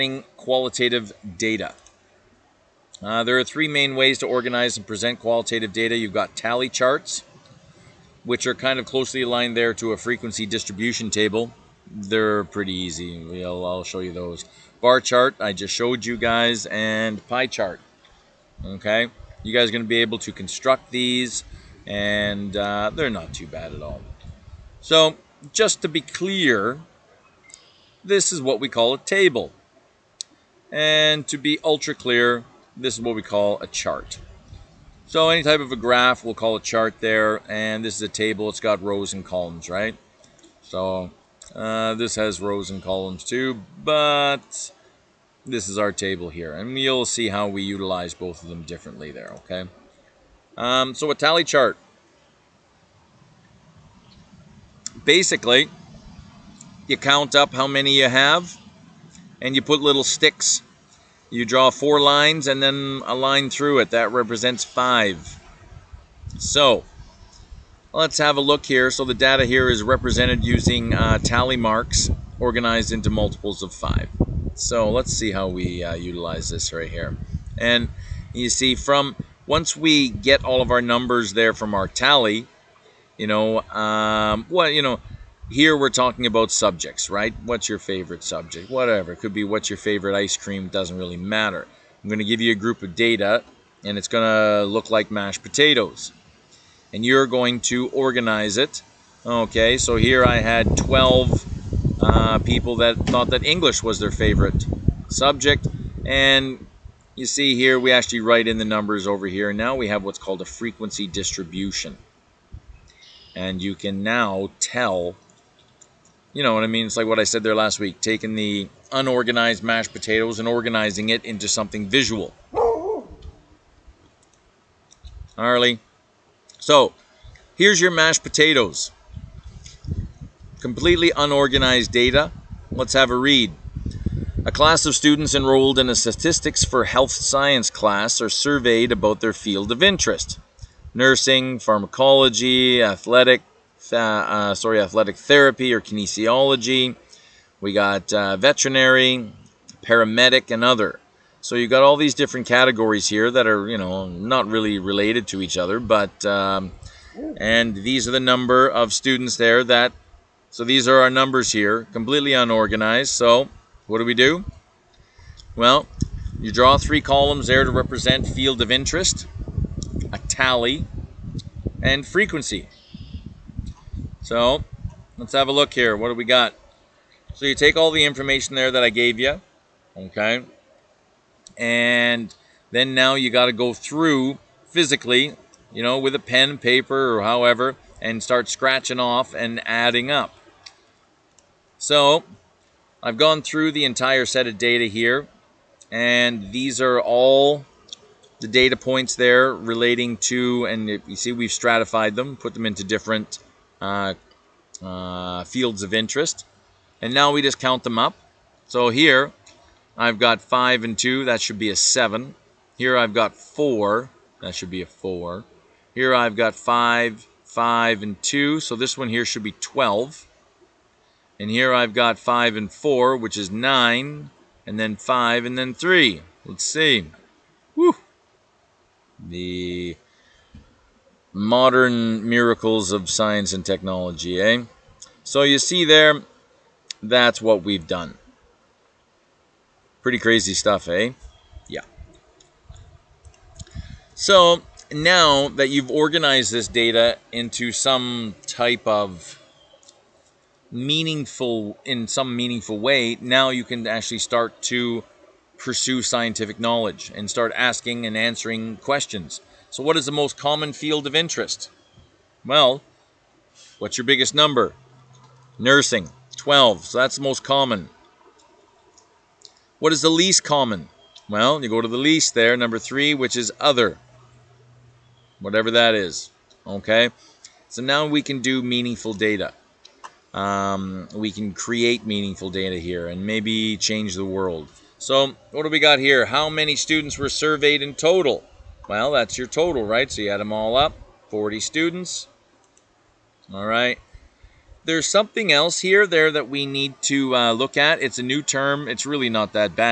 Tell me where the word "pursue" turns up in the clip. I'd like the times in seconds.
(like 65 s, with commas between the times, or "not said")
255 s.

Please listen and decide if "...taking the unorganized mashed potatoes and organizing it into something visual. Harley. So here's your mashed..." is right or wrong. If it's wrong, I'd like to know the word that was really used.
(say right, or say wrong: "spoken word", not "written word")
right.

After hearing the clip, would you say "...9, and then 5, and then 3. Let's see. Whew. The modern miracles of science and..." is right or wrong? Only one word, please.
right.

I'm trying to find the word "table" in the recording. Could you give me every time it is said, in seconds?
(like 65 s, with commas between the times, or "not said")
11 s, 28 s, 38 s, 45 s.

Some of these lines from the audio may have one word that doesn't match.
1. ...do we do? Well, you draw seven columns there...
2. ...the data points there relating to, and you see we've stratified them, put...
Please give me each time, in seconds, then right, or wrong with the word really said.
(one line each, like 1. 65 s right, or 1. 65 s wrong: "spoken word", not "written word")
1. 163 s wrong: "three", not "seven"
2. 198 s right.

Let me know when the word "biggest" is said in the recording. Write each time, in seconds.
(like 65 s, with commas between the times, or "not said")
264 s.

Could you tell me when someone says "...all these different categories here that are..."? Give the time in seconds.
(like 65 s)
151 s.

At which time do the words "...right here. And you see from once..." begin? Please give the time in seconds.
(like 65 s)
76 s.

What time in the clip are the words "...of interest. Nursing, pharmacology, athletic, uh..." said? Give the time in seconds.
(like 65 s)
139 s.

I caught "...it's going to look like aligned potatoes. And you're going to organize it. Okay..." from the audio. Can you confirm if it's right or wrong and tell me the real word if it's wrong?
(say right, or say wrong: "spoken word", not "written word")
wrong: "mashed", not "aligned".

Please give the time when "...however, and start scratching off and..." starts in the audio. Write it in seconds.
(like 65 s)
187 s.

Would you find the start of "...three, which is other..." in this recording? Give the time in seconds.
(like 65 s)
272 s.